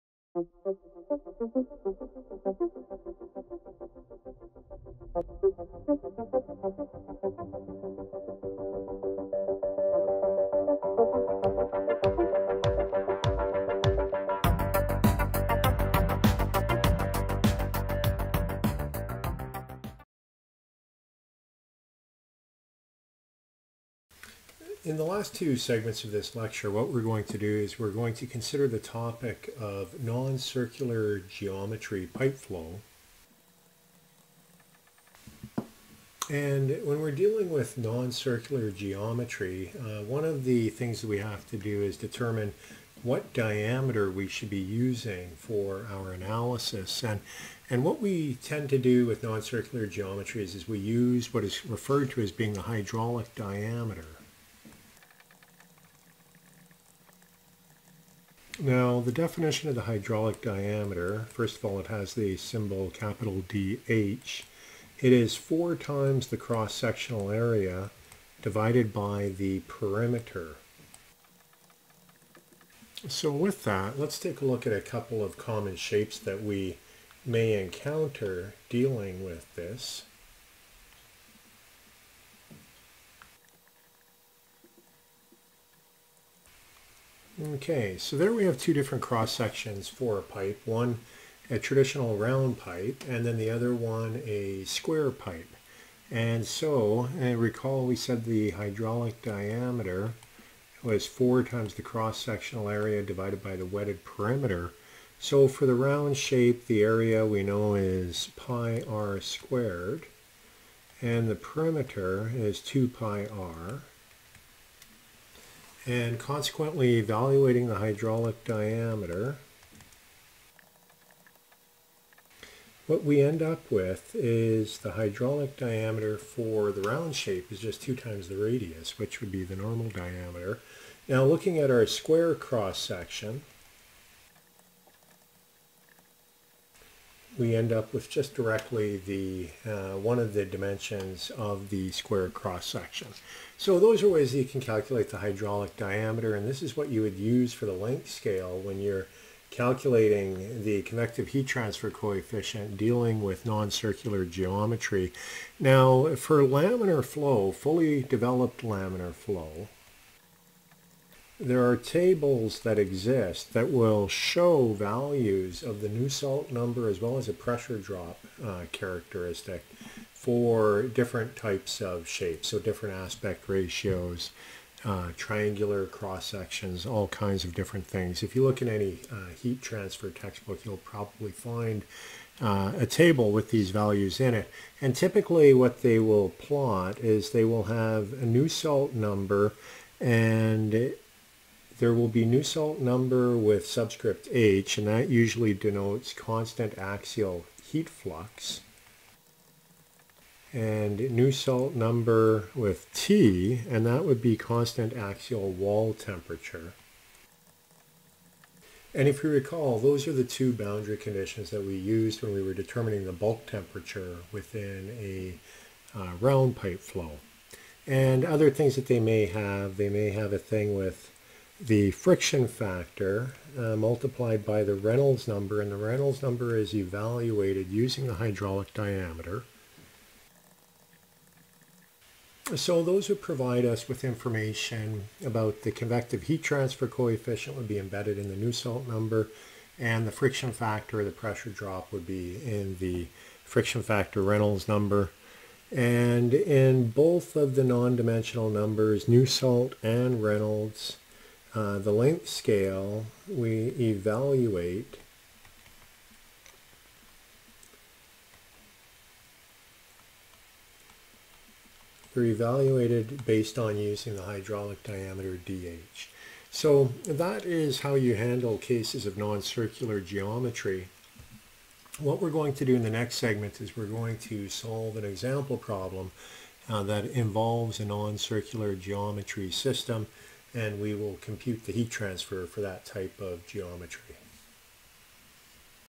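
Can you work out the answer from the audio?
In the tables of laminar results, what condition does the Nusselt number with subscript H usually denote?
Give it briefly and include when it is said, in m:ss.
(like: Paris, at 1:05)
constant axial heat flux, at 3:16.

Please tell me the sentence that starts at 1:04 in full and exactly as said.
It is four times the cross-sectional area divided by the perimeter.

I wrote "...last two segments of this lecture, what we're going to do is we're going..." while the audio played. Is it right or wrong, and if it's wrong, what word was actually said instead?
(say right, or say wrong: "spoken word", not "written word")
right.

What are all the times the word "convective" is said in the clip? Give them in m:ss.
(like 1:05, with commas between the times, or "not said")
2:30, 3:55.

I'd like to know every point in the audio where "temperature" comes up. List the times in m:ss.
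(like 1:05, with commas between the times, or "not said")
3:25, 3:33.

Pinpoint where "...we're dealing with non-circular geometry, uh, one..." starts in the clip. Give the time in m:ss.
0:37.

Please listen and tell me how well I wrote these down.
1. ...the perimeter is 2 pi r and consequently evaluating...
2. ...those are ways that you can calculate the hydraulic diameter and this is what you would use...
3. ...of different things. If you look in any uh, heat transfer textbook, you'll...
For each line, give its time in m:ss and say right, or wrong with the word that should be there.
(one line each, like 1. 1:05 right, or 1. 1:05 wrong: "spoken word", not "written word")
1. 1:51 right
2. 2:23 right
3. 2:57 right.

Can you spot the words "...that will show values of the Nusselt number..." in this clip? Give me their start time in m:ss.
2:43.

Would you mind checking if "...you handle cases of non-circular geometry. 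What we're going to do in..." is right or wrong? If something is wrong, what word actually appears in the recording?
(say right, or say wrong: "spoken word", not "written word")
right.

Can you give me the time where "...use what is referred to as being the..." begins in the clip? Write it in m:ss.
0:50.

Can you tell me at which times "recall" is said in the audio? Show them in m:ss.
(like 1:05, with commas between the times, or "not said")
1:37, 3:29.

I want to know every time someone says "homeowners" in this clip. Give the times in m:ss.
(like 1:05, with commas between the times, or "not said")
not said.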